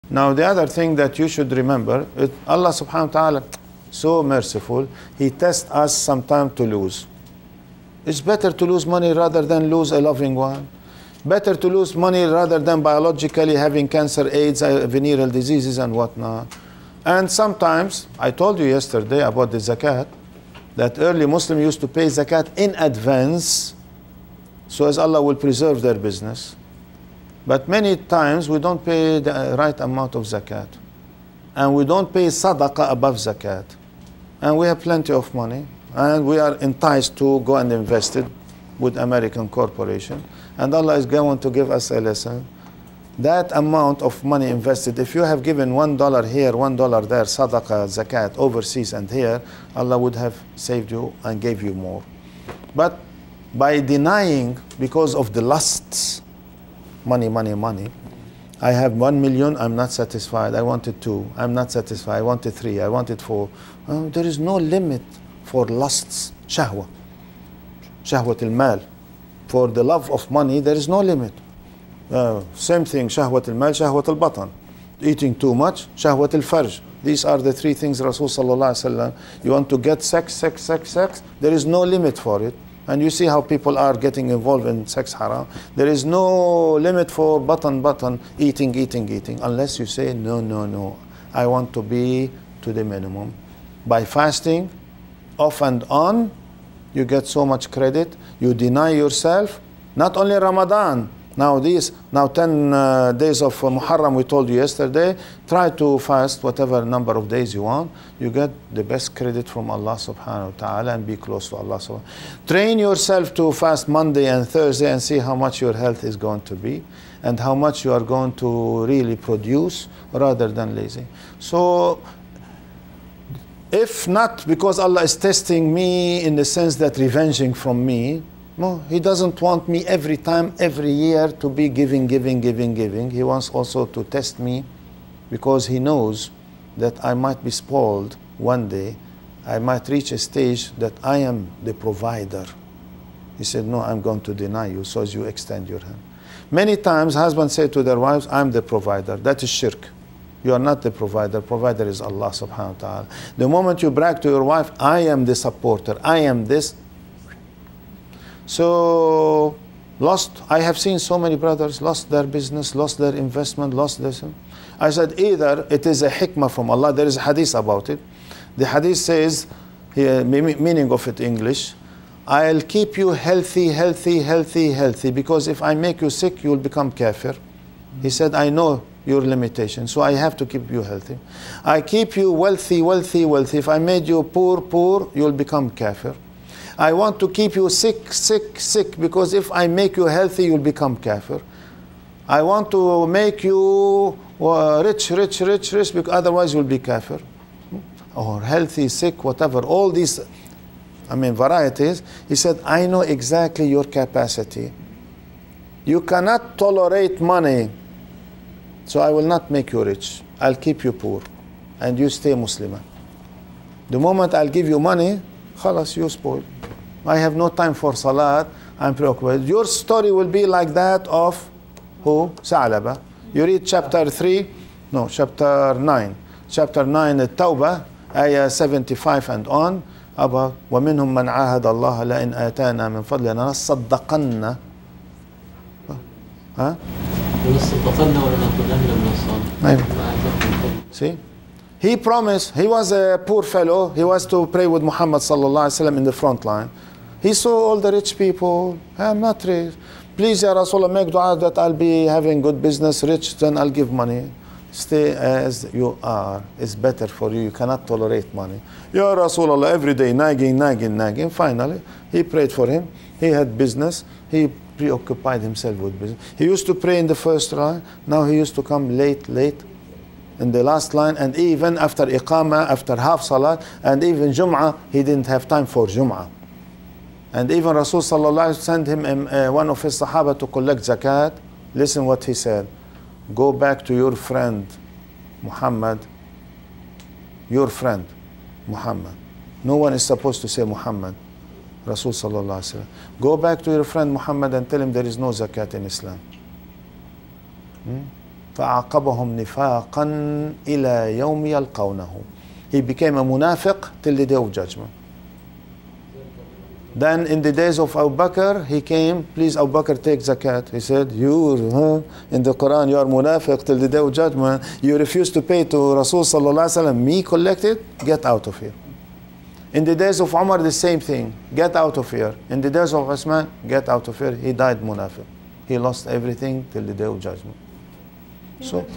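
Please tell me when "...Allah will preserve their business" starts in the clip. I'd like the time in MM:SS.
00:24.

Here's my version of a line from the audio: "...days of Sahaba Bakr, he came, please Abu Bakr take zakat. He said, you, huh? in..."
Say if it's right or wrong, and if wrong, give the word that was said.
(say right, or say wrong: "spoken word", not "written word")
wrong: "Abu", not "Sahaba".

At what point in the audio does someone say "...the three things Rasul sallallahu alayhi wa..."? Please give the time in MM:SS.
01:17.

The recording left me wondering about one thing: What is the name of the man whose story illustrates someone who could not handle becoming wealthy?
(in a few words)
Sa'alaba.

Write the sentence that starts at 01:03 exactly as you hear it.
Uh, there is no limit for lusts, shahwa, shahwat al-mal.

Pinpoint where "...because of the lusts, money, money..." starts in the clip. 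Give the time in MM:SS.
00:54.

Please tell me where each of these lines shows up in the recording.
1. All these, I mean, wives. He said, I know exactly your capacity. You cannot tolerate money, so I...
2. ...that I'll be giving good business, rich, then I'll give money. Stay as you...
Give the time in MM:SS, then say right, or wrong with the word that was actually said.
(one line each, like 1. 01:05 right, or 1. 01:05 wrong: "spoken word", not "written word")
1. 03:19 wrong: "varieties", not "wives"
2. 04:11 wrong: "having", not "giving".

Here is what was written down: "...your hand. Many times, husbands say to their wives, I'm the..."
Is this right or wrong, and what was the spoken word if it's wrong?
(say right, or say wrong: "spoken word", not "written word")
right.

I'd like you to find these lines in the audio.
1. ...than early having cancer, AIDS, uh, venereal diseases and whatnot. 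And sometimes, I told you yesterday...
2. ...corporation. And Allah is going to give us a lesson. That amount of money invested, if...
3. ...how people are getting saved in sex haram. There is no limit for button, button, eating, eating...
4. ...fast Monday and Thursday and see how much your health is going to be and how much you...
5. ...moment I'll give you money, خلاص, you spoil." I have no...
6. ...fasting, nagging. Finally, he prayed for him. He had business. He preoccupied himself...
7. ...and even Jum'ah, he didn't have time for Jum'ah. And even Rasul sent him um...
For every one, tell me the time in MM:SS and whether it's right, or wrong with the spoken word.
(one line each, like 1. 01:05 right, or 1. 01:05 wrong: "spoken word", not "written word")
1. 00:12 wrong: "biologically", not "early"
2. 00:39 right
3. 01:23 wrong: "involved", not "saved"
4. 01:53 right
5. 03:33 right
6. 04:20 wrong: "nagging", not "fasting"
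7. 04:33 right.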